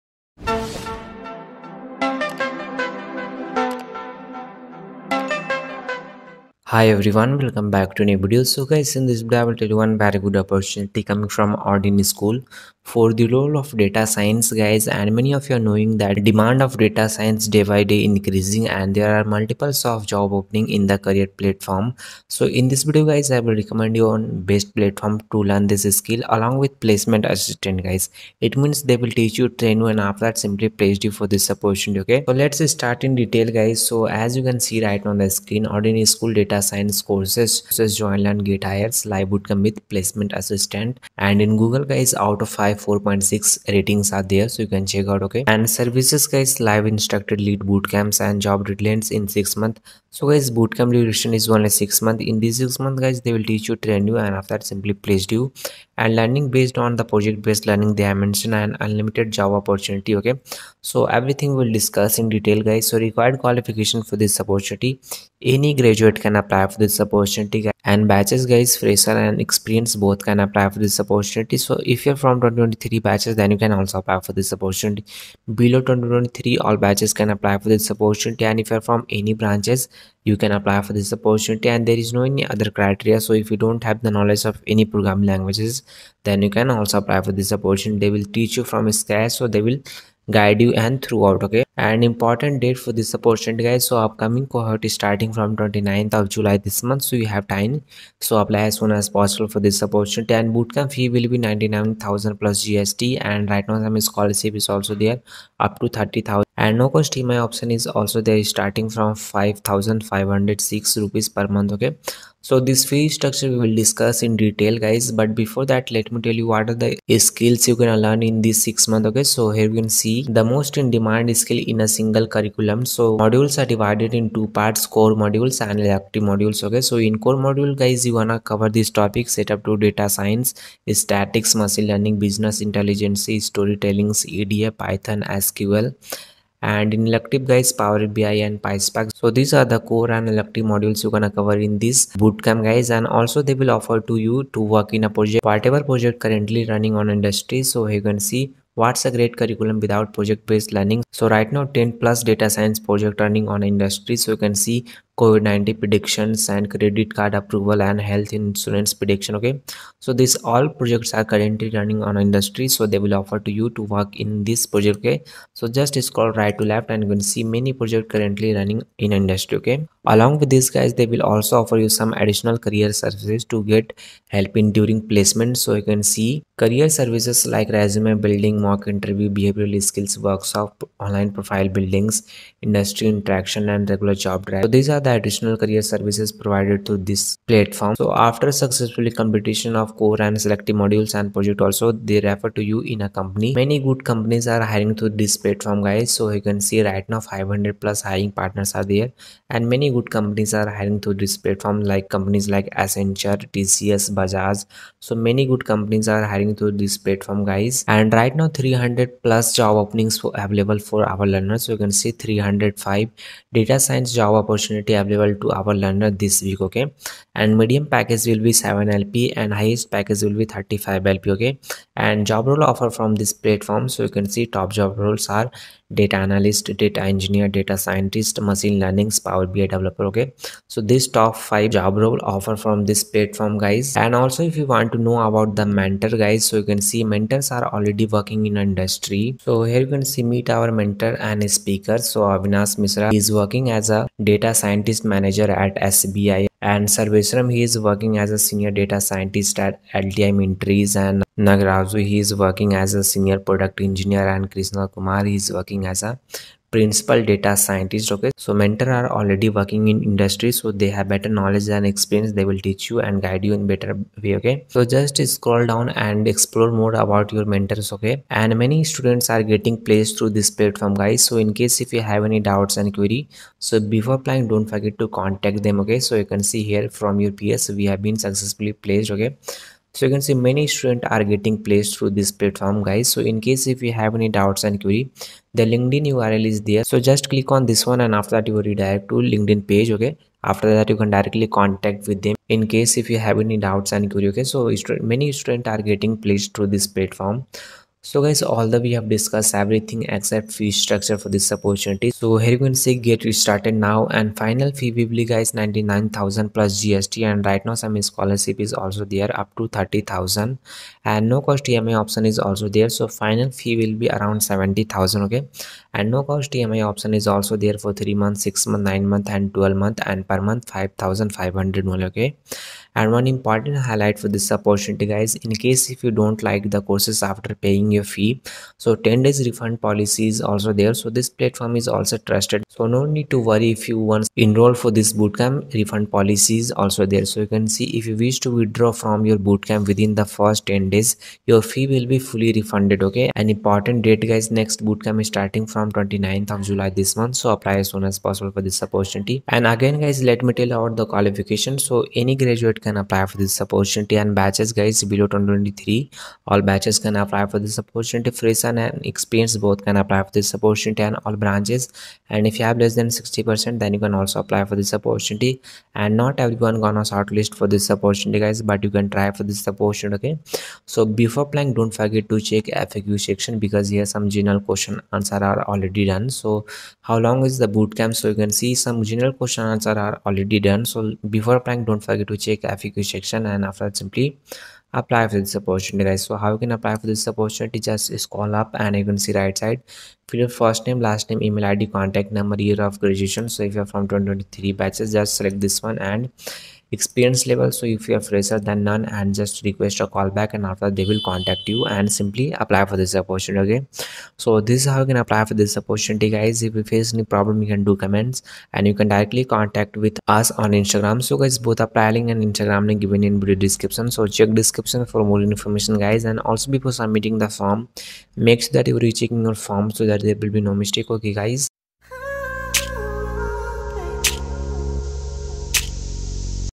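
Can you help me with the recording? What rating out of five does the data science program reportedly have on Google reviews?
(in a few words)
4.6.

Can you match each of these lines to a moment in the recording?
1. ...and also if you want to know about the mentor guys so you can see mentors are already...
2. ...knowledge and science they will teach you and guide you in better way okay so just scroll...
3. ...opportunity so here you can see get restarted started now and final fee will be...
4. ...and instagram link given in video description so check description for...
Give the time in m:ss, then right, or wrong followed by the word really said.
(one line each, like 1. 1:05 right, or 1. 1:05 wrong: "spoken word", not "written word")
1. 3:54 right
2. 4:21 wrong: "experience", not "science"
3. 5:01 right
4. 6:52 right.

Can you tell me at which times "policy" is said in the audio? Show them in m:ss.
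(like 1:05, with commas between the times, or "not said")
5:29, 5:36.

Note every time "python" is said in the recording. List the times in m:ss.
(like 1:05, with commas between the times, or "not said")
2:14.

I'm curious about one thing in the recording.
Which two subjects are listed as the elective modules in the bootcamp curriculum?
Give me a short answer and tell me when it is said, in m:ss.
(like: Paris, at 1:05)
Power BI and PySpark, at 2:17.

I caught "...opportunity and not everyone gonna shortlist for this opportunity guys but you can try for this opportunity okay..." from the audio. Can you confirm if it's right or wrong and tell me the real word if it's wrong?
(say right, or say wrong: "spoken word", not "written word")
right.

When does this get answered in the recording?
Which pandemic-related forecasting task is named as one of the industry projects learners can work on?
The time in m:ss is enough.
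2:35.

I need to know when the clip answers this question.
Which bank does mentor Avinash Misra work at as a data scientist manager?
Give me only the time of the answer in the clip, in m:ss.
4:05.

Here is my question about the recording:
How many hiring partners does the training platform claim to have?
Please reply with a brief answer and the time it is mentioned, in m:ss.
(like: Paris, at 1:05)
500+, at 3:17.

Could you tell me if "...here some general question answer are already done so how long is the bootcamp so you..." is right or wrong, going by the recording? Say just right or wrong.
right.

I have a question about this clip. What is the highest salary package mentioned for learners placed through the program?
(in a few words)
35 LPA.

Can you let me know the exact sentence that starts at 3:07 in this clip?
So after successfully completion of core and selective modules and project also they refer to you in a company.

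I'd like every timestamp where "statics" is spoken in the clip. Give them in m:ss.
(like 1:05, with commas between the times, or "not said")
2:10.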